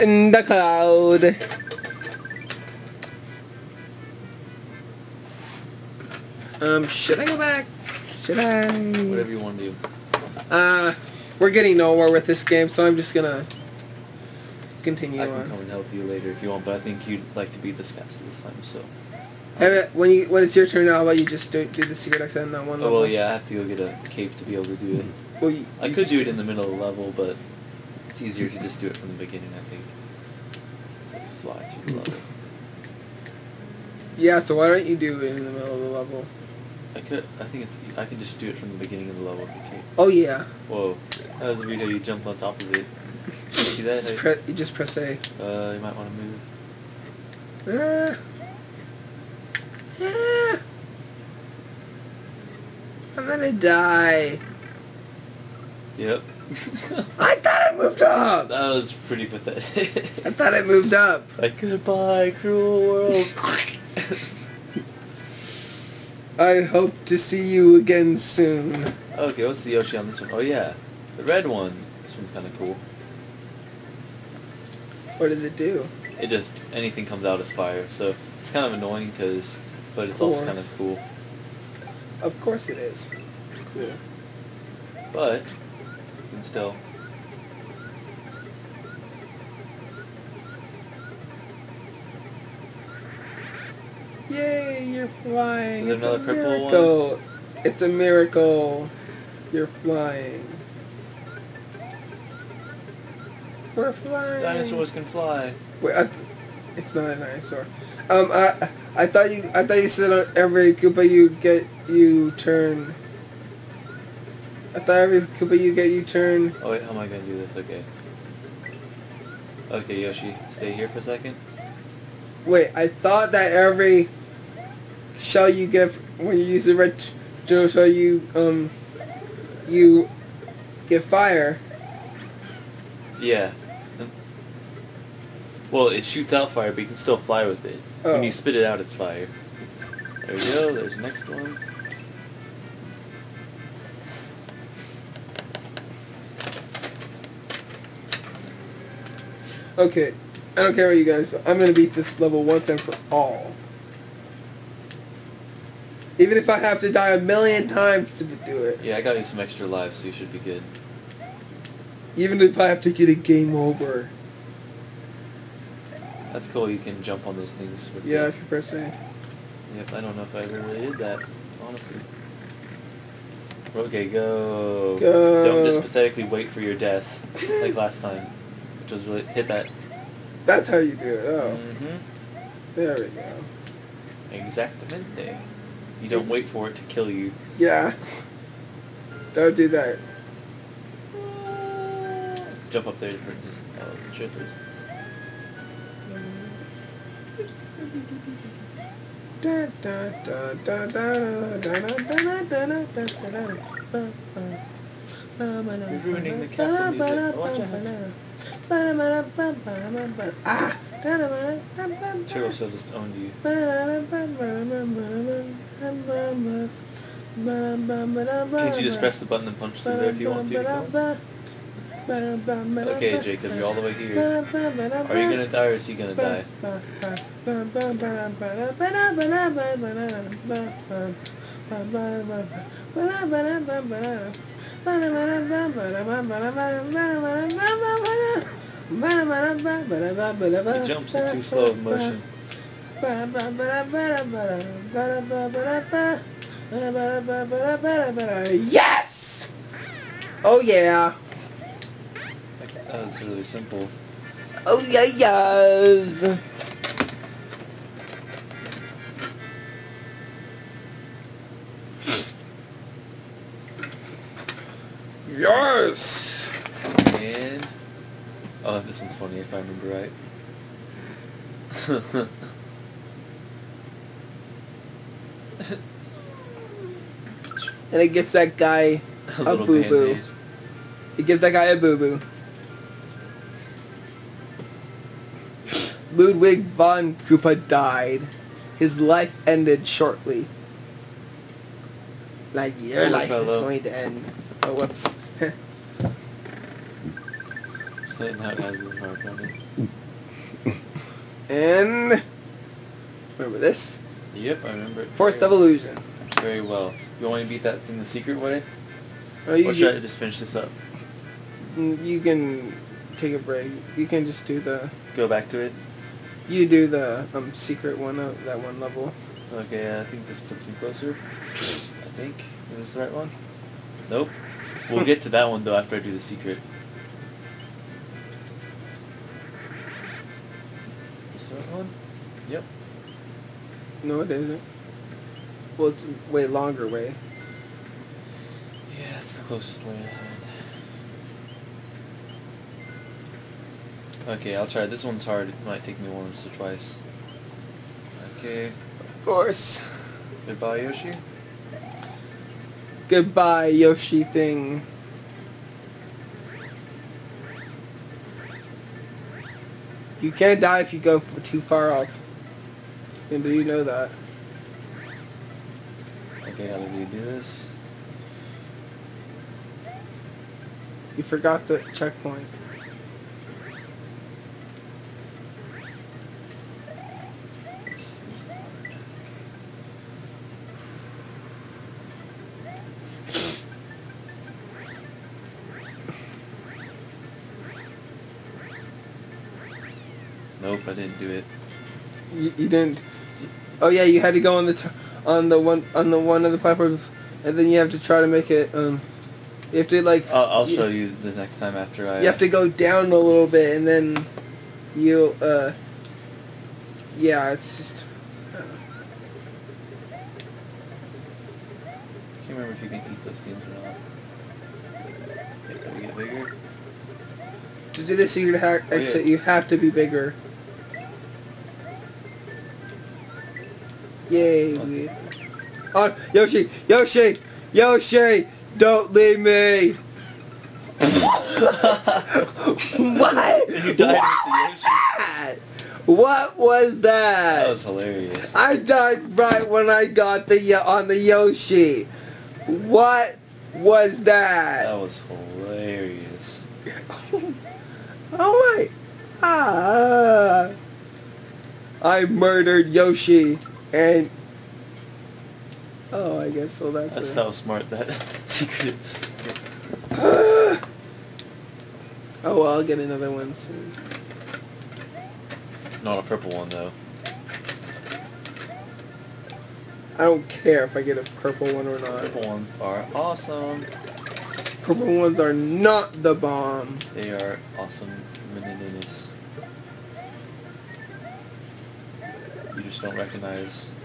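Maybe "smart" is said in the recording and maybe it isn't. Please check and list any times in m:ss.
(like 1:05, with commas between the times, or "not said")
7:37.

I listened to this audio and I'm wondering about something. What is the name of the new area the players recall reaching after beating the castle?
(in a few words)
Forest of Illusion.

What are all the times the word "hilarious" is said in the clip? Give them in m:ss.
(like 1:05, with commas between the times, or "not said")
7:17, 7:25.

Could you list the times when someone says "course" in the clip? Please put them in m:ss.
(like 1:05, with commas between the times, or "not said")
1:22, 5:49.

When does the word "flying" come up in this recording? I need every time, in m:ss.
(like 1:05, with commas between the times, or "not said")
1:35, 1:39, 1:43.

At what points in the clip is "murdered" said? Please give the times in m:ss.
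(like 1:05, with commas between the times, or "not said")
7:32.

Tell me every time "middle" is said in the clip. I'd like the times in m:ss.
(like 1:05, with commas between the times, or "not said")
0:26, 0:35.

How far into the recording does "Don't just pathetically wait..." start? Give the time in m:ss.
2:55.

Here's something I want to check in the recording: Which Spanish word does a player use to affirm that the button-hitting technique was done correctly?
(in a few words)
Exactamente.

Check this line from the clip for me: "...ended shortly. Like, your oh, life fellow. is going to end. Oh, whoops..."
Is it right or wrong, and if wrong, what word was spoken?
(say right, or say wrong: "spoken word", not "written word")
right.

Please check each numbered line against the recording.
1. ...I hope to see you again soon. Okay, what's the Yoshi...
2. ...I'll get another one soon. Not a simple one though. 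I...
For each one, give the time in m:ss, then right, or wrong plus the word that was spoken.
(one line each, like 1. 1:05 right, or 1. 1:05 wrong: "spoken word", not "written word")
1. 1:06 right
2. 7:42 wrong: "purple", not "simple".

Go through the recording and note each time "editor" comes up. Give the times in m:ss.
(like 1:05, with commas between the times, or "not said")
not said.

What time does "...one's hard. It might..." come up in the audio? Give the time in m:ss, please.
5:45.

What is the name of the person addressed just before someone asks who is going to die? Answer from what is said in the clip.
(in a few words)
Jacob.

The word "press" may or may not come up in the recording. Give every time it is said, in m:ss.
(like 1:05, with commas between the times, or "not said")
0:44, 2:48, 3:38.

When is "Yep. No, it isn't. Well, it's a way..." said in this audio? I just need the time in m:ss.
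5:32.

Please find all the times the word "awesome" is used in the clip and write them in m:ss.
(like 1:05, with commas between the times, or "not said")
7:53, 7:57.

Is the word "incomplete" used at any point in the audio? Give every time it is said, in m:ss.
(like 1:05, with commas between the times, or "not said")
not said.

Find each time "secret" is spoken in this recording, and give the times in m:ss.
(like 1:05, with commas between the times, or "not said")
0:21, 5:08, 5:17, 5:26, 6:58, 7:38.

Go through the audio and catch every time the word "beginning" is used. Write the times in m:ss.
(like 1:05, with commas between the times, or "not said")
0:29, 0:38.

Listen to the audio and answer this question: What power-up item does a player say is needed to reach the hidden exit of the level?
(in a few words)
A cape.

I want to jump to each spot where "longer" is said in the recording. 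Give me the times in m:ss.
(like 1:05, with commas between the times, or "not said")
5:36.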